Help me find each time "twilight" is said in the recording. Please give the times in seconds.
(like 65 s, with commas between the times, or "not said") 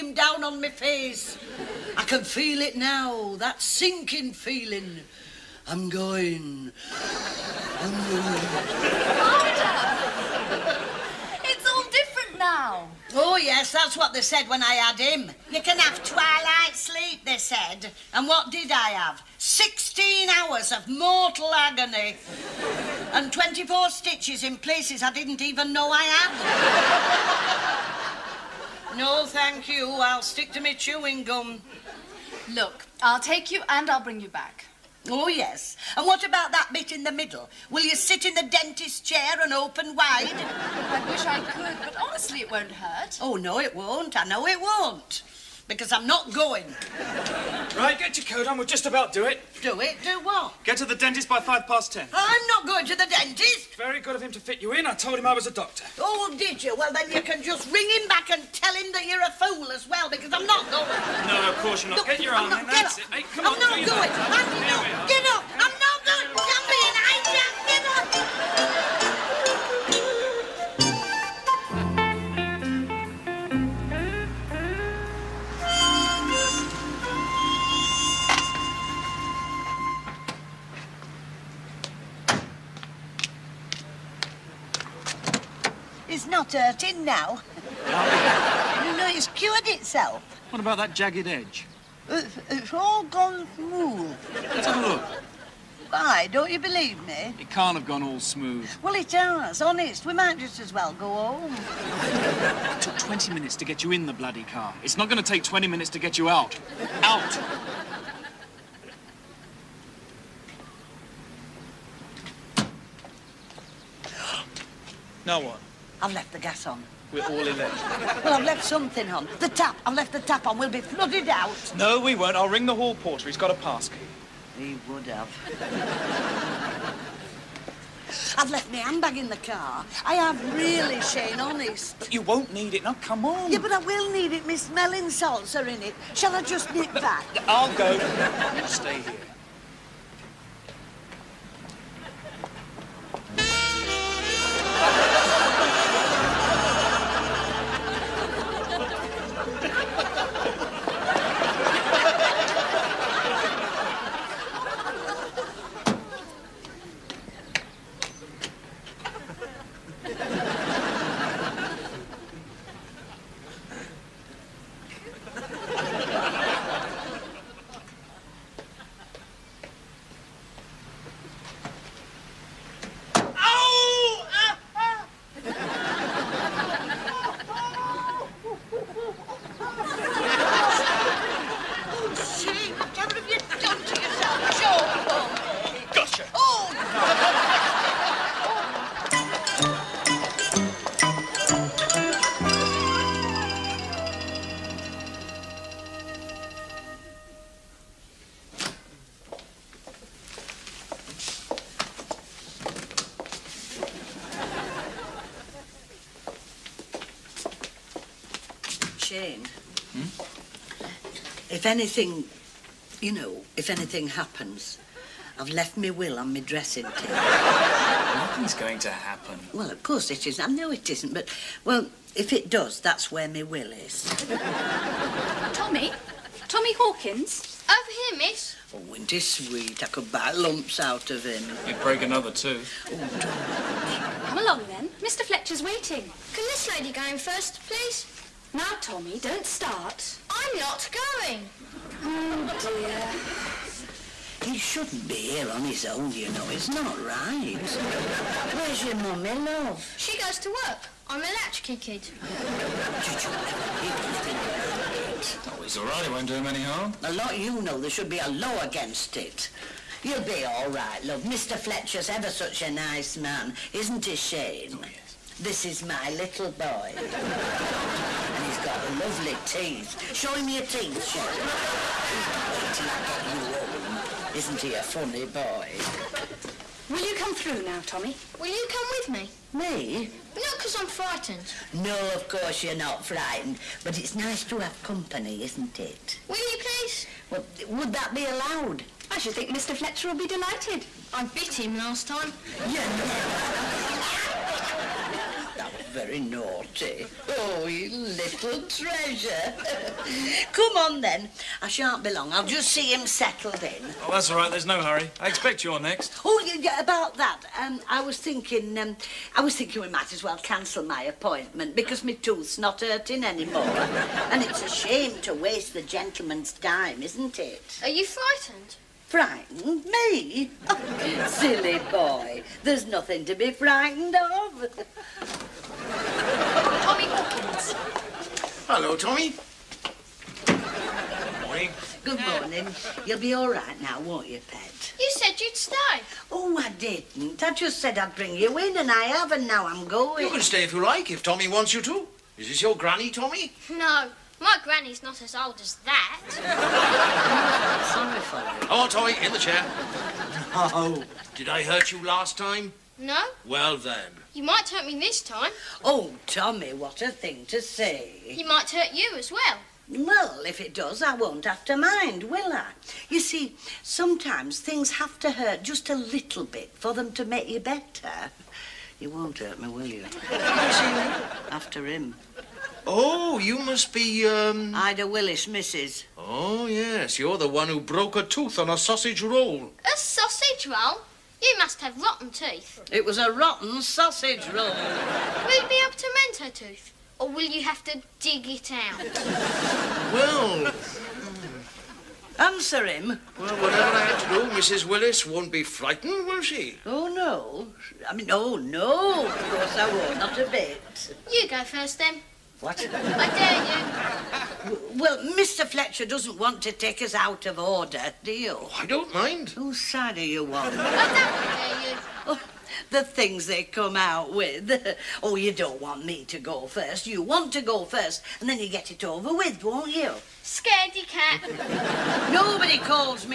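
16 s.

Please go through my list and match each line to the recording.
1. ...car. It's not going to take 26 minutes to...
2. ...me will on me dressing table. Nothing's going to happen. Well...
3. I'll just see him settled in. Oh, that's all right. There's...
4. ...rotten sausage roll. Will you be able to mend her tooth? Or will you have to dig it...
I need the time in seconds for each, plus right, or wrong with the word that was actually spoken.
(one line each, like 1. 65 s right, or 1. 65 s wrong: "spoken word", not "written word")
1. 104 s wrong: "20", not "26"
2. 215 s right
3. 302 s right
4. 383 s right.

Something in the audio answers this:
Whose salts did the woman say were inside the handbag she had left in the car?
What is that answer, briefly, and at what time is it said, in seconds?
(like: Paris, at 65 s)
Miss Mellins', at 134 s.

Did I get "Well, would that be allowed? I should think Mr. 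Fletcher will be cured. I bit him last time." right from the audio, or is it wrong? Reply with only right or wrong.
wrong.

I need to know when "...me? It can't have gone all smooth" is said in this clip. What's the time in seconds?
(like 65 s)
97 s.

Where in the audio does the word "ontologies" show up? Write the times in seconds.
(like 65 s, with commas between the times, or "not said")
not said.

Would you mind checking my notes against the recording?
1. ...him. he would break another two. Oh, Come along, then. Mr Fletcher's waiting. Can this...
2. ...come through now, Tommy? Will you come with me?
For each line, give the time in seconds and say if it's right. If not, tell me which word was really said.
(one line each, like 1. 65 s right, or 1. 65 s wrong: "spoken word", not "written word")
1. 231 s right
2. 277 s right.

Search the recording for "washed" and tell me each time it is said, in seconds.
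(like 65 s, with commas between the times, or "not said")
not said.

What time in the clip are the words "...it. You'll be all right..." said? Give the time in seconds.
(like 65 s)
259 s.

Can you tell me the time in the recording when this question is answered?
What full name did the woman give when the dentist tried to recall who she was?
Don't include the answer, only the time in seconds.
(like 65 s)
374 s.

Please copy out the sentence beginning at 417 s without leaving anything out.
You want to go first, and then you get it over with, won't you?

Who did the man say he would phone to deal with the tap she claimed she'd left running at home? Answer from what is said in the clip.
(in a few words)
the hall porter.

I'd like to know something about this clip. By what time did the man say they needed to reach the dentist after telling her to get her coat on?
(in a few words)
five past ten.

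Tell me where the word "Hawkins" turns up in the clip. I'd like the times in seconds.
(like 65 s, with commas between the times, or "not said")
226 s, 327 s.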